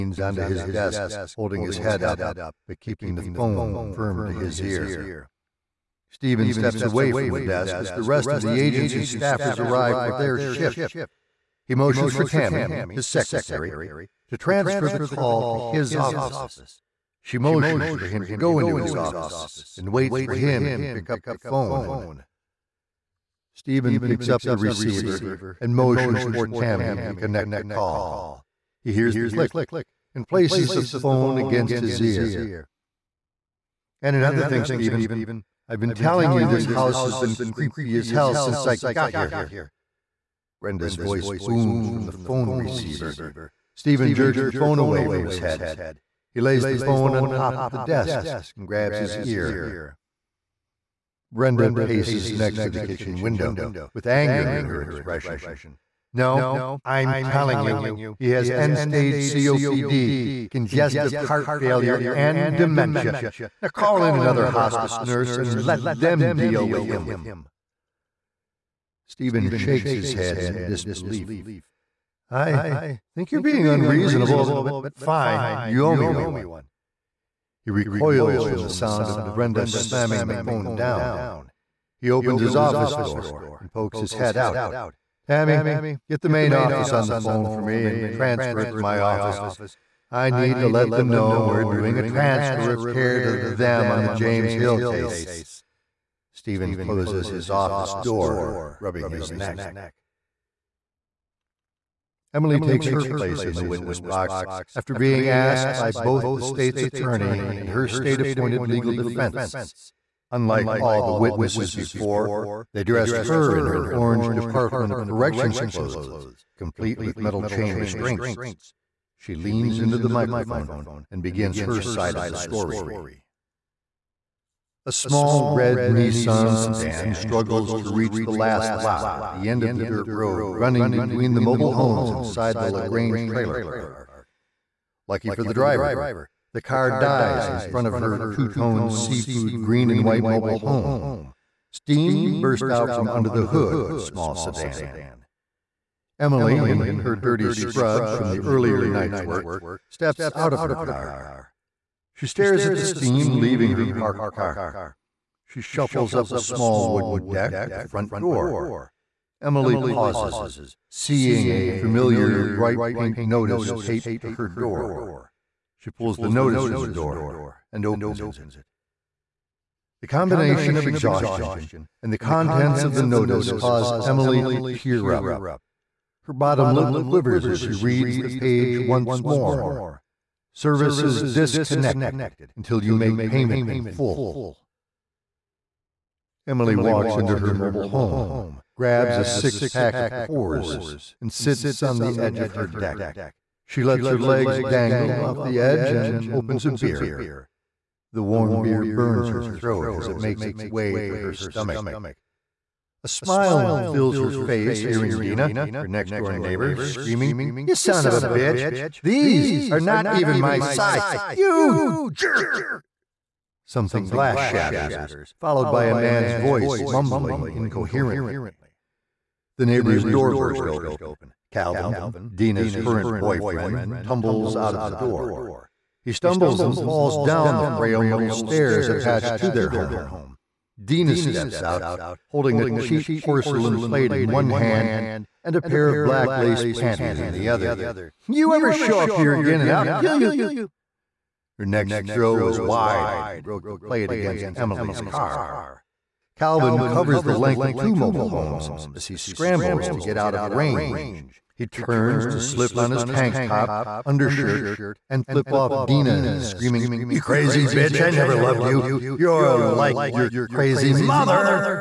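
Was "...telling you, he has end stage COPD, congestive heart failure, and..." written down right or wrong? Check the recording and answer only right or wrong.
right.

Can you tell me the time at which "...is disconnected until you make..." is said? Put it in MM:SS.
03:01.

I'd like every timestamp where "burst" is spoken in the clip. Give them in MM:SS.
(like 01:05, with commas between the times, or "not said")
02:22, 03:40.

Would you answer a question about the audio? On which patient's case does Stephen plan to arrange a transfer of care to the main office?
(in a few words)
James Hill.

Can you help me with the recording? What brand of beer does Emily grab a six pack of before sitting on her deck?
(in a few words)
Coors.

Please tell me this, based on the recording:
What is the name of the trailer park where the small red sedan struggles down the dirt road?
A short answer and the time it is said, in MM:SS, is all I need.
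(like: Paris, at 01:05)
LaGrange, at 02:12.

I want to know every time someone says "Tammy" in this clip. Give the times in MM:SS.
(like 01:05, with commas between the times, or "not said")
00:12, 00:26, 01:25.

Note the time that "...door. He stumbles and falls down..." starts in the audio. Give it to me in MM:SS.
03:44.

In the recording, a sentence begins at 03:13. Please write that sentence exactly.
She lets her legs dangle off the edge and opens a beer.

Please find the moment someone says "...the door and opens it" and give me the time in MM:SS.
02:46.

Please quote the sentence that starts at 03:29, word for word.
These are not even my size!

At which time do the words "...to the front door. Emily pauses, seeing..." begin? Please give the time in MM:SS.
02:37.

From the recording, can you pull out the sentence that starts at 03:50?
Dina steps out, holding a cheap porcelain plate in one hand and a pair of black lace panties in the other.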